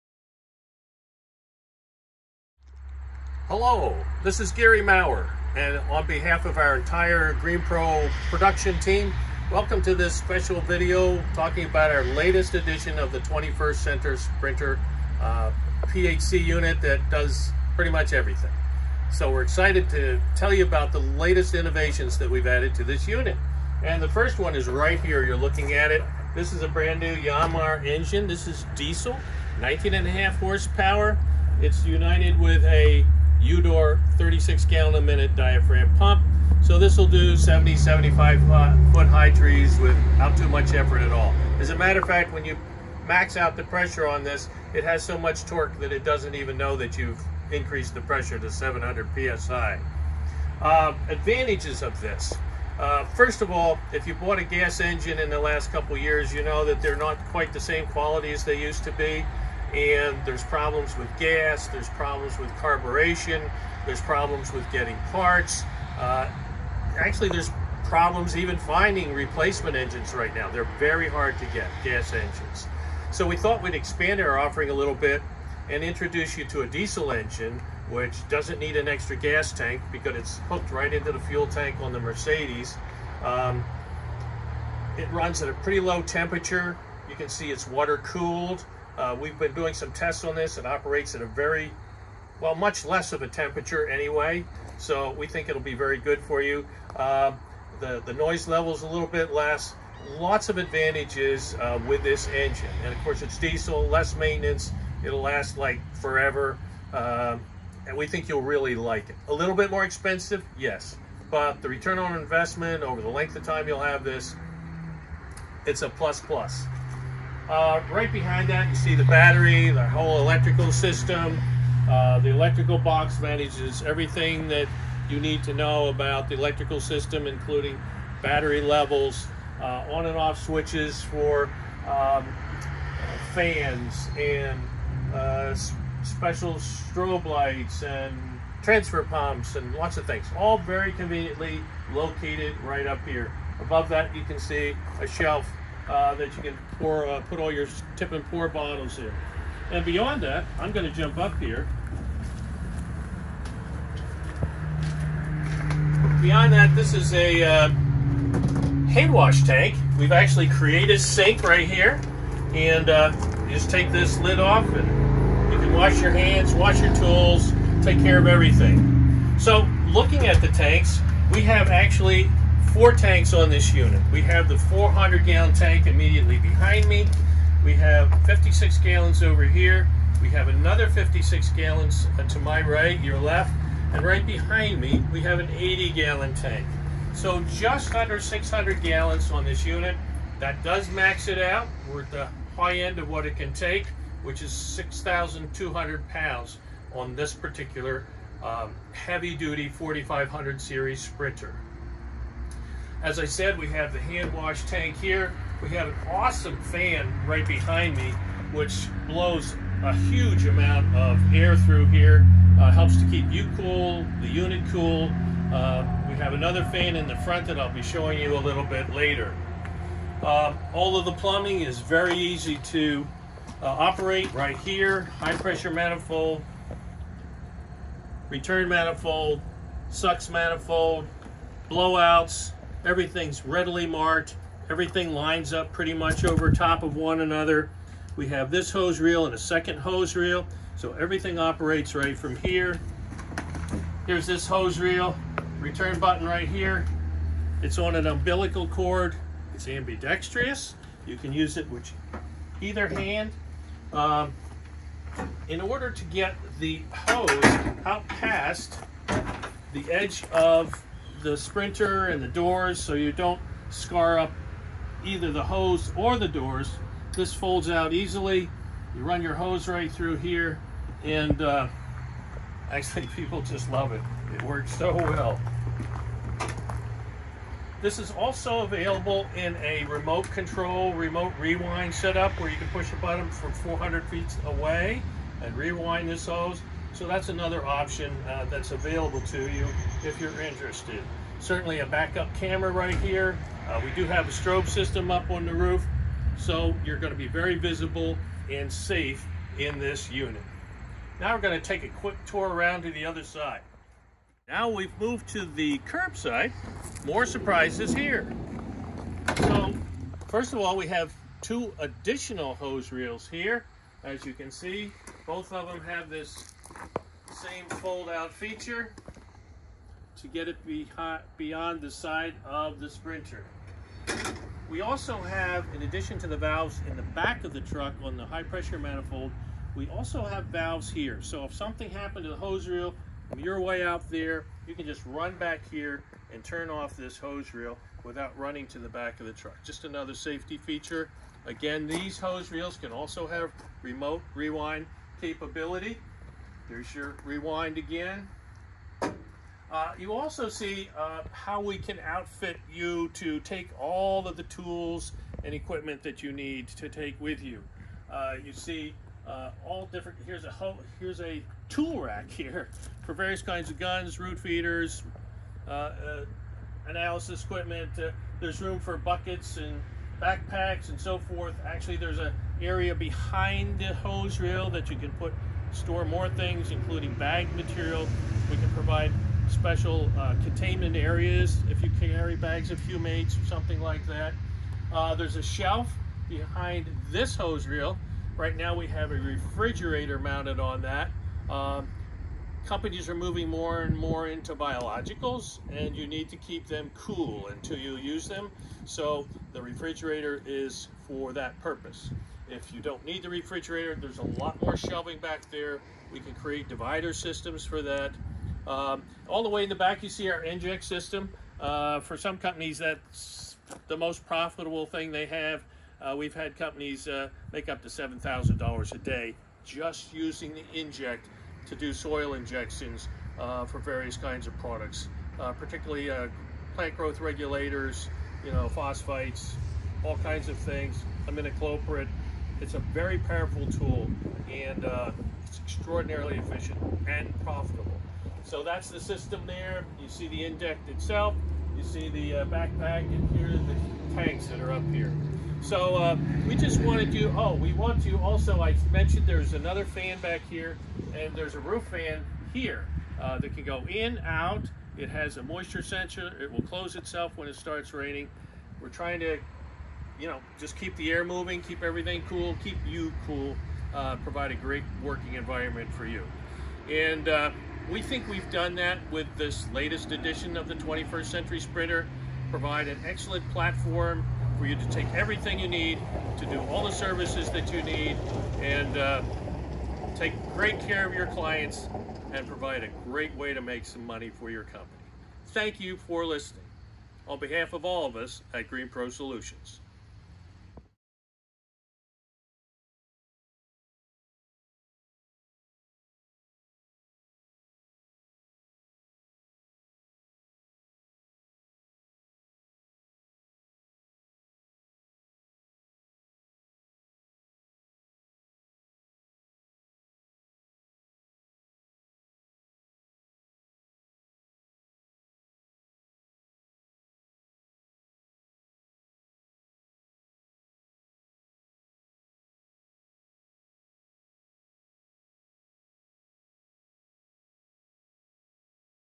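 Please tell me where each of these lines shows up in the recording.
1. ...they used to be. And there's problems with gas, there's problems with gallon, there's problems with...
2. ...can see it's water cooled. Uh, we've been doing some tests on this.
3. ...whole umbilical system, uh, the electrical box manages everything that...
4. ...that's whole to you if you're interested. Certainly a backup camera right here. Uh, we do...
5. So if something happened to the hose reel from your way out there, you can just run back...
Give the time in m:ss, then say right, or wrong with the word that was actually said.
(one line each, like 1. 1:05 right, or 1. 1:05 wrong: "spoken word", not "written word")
1. 0:58 wrong: "carburation", not "gallon"
2. 1:27 right
3. 1:59 wrong: "electrical", not "umbilical"
4. 4:48 wrong: "available", not "whole"
5. 5:31 right.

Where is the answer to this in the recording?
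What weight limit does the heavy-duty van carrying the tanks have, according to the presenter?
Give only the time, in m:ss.
3:14.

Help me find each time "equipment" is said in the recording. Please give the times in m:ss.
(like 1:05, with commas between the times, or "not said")
5:55, 6:07.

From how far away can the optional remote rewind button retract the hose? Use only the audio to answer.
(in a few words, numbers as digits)
400 feet.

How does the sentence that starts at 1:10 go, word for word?
They're very hard to get, gas engines.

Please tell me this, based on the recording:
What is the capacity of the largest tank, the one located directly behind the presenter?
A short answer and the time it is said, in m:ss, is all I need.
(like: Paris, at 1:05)
400 gallons, at 2:54.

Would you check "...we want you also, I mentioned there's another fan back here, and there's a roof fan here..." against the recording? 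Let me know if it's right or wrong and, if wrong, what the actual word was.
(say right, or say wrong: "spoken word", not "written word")
right.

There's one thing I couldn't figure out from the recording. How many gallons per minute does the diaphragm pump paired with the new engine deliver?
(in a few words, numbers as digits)
36.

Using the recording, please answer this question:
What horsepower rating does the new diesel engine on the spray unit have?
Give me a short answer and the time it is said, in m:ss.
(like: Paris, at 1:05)
19.5, at 0:29.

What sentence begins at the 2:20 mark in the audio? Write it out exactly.
All very conveniently located right up here.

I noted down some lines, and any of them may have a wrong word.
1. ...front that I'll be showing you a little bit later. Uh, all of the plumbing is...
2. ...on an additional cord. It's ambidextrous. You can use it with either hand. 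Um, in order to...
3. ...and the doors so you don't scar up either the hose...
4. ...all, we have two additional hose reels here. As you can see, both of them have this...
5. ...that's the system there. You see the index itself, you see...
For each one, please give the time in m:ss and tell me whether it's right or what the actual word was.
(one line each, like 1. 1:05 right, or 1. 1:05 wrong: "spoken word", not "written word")
1. 3:37 right
2. 4:07 wrong: "umbilical", not "additional"
3. 4:22 right
4. 5:10 right
5. 7:18 right.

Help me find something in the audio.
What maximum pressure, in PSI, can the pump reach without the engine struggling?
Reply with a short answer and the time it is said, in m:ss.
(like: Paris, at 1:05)
700, at 0:48.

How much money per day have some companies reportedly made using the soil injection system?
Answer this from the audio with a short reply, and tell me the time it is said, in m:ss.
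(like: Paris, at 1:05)
$7,000, at 6:57.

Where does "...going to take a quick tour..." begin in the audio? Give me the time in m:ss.
5:01.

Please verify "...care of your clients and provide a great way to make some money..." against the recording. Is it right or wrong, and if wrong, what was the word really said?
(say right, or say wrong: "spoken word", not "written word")
right.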